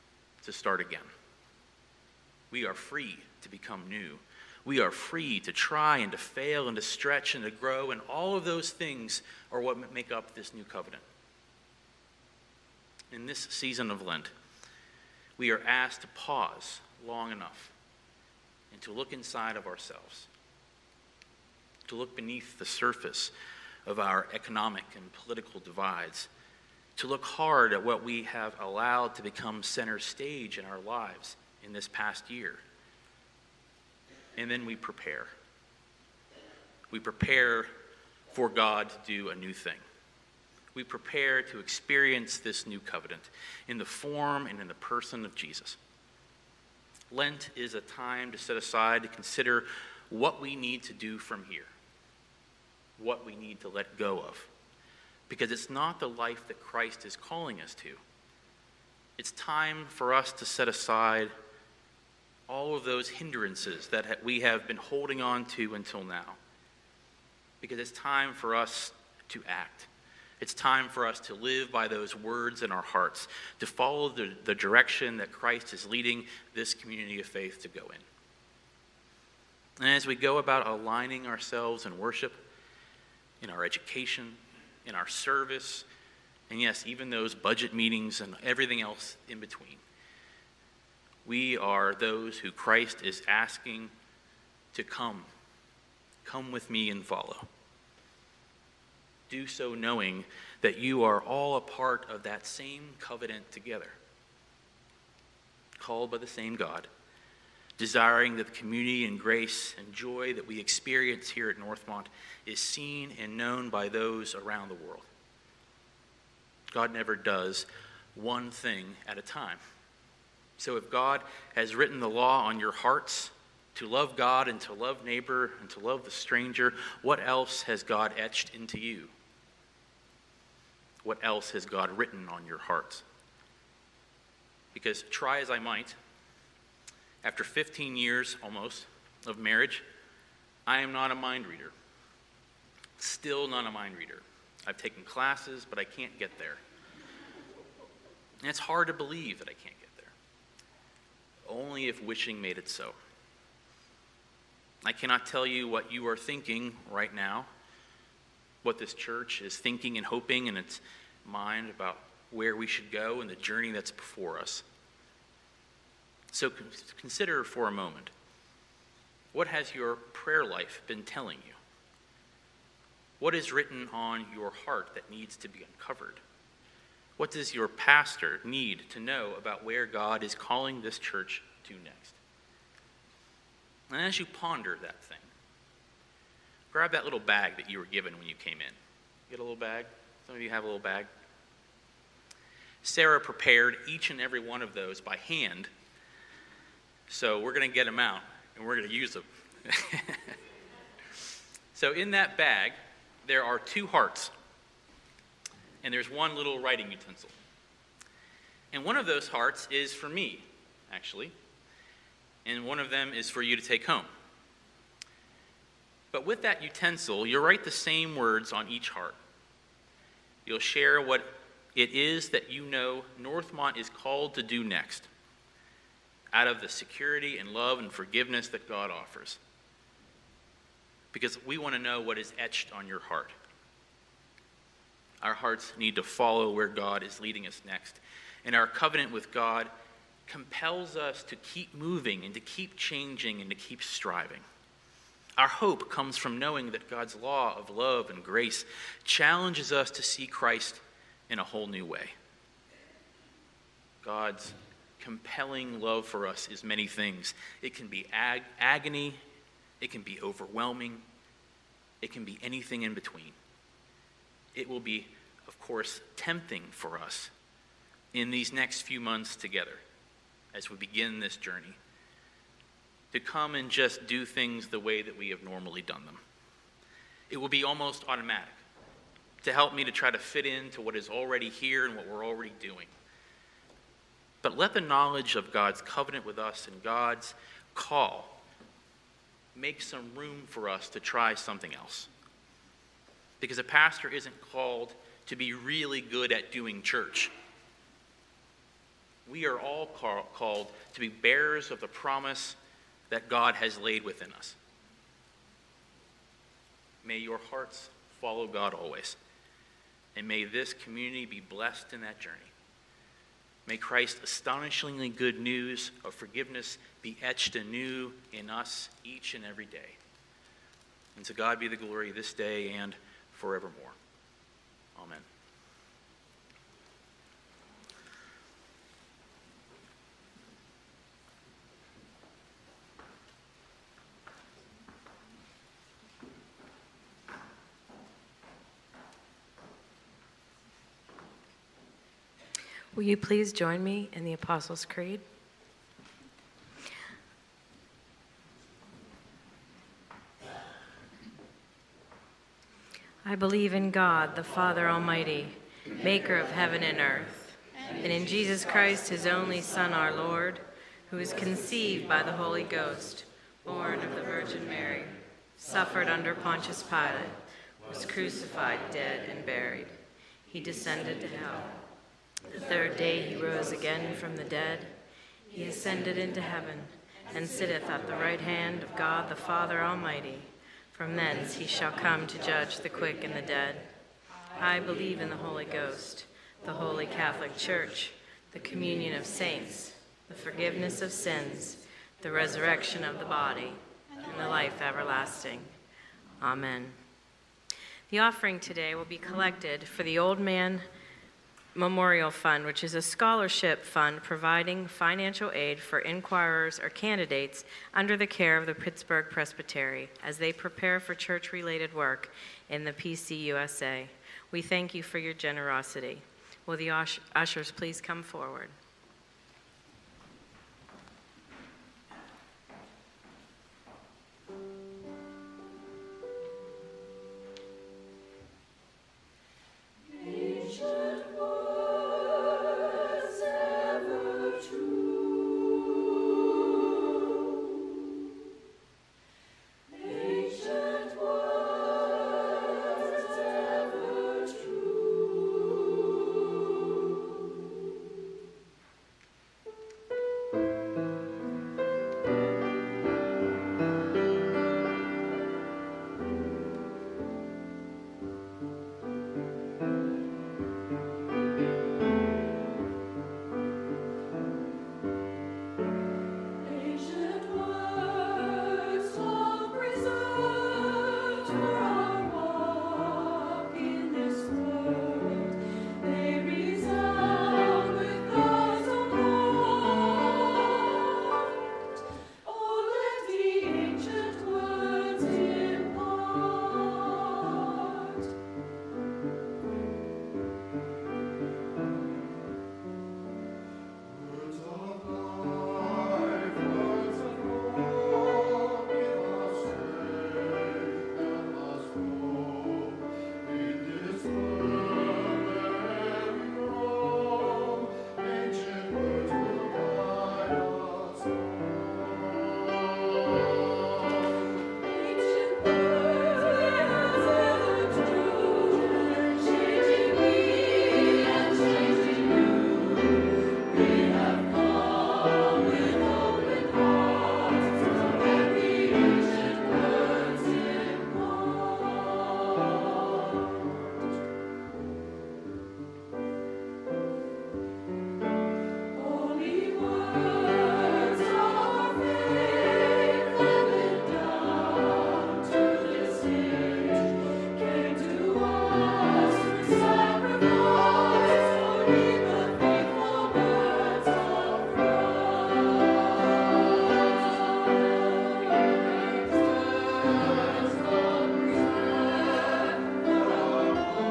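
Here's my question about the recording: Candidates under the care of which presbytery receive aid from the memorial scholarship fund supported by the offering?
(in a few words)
Pittsburgh Presbytery.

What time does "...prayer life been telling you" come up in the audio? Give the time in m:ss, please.
2:49.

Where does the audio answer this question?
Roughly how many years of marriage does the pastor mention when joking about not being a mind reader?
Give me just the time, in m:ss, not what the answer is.
2:17.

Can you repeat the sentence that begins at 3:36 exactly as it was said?
But with that utensil, you'll write the same words on each heart.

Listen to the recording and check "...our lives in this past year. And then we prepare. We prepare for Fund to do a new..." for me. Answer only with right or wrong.
wrong.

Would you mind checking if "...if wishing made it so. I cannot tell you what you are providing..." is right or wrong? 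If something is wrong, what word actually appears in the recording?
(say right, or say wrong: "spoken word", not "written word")
wrong: "thinking", not "providing".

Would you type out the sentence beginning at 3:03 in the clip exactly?
And as you ponder that thing, grab that little bag that you were given when you came in.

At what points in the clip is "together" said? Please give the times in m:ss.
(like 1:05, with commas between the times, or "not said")
1:43, 4:29.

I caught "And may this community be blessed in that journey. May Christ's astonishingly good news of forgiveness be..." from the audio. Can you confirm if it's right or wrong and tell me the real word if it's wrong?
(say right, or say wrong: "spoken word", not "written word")
right.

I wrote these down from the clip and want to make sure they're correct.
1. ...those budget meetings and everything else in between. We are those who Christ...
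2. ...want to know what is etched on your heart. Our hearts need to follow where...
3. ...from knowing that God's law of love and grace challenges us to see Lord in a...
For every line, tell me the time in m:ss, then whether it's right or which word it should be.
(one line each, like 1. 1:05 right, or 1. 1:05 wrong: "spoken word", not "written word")
1. 1:27 right
2. 3:51 right
3. 4:06 wrong: "Christ", not "Lord".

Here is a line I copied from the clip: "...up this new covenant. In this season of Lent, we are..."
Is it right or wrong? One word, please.
right.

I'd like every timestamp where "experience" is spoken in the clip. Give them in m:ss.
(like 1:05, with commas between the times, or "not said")
0:41, 1:50.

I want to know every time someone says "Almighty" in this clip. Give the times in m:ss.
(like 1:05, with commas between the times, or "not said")
5:54, 6:19.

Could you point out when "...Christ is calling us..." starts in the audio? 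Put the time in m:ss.
0:56.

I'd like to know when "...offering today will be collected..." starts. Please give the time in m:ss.
6:38.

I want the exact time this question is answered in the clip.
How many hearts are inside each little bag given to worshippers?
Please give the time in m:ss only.
3:23.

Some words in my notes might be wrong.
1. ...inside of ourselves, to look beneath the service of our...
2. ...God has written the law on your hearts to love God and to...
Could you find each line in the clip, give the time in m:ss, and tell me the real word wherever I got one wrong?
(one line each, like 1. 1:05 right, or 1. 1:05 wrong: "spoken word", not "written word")
1. 0:19 wrong: "surface", not "service"
2. 2:00 right.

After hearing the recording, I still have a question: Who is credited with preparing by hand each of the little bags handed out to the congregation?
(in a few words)
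Sarah.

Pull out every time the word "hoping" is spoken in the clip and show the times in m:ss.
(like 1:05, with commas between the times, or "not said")
2:40.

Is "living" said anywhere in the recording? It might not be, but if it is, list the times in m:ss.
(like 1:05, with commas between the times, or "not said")
not said.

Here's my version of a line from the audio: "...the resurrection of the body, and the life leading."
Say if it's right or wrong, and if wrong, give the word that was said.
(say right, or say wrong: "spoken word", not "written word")
wrong: "everlasting", not "leading".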